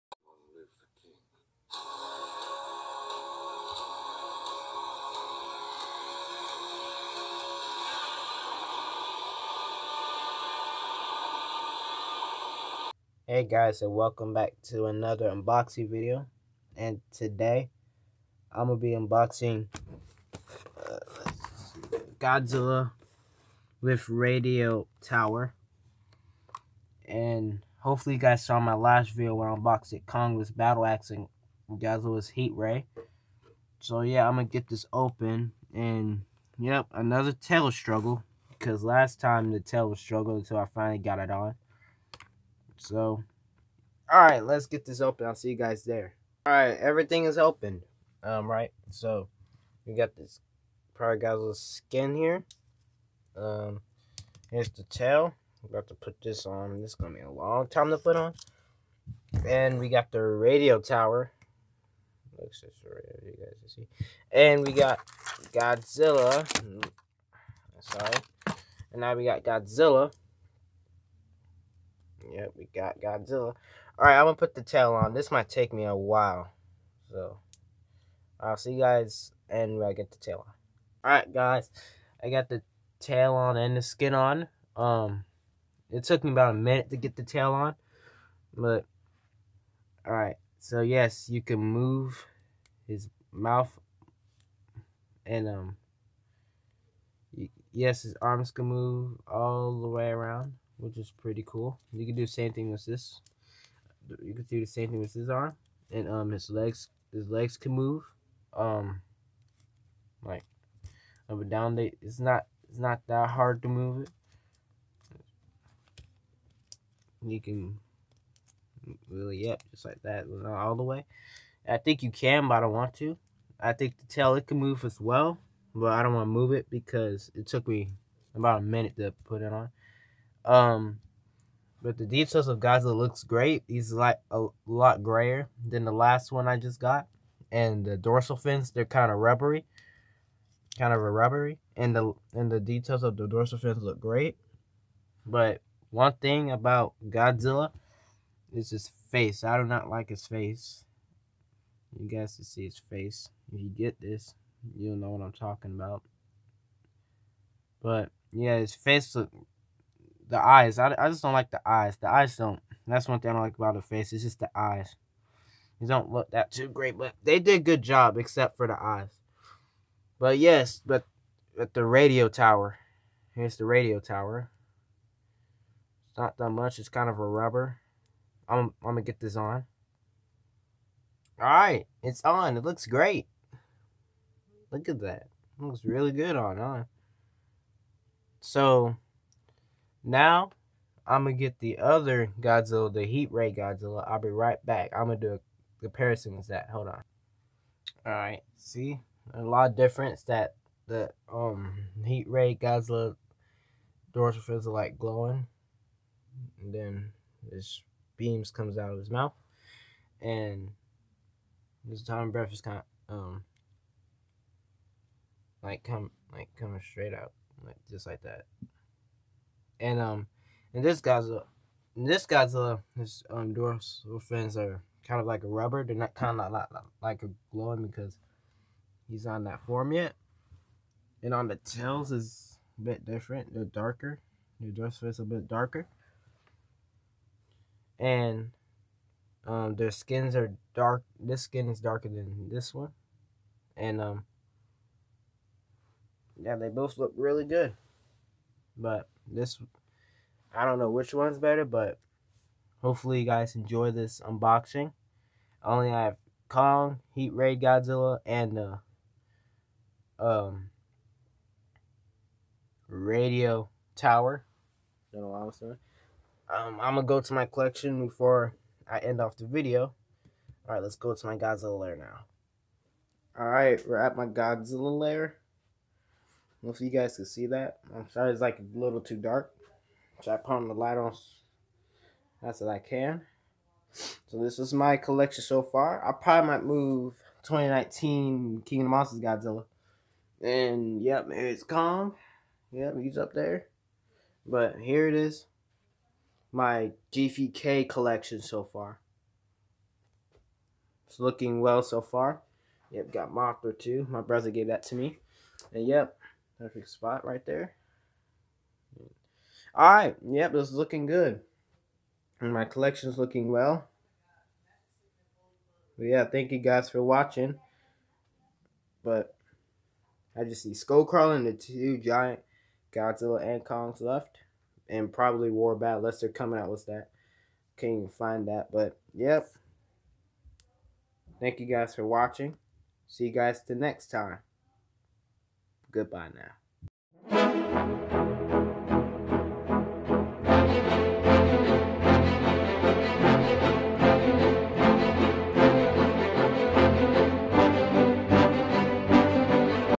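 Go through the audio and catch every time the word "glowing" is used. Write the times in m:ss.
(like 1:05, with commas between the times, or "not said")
3:24, 3:47.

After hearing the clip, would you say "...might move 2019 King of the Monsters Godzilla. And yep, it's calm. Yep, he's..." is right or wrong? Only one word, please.
right.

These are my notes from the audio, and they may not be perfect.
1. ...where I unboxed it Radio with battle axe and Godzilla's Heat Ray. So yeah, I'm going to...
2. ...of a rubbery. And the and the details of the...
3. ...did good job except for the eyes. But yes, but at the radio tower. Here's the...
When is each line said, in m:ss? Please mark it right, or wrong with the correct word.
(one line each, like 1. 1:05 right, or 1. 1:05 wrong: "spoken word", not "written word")
1. 0:29 wrong: "Kong", not "Radio"
2. 2:20 right
3. 2:47 right.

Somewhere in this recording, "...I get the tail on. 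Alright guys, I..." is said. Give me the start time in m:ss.
1:19.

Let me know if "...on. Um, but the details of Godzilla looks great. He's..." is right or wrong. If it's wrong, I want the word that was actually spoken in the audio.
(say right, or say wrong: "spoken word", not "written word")
right.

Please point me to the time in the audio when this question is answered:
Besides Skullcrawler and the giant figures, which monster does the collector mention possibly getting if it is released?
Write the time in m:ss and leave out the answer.
5:25.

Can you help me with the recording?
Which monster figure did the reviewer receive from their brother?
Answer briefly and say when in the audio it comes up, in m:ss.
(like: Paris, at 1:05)
Mothra, at 5:03.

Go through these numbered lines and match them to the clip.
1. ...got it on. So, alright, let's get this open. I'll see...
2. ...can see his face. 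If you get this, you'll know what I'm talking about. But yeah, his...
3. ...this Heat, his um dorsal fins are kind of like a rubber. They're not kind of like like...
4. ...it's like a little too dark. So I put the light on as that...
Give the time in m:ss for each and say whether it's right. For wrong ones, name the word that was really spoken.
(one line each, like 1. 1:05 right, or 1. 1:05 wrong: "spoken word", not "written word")
1. 0:40 right
2. 2:32 right
3. 3:42 wrong: "Godzilla", not "Heat"
4. 4:38 right.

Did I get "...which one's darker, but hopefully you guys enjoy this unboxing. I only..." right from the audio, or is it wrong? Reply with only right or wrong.
wrong.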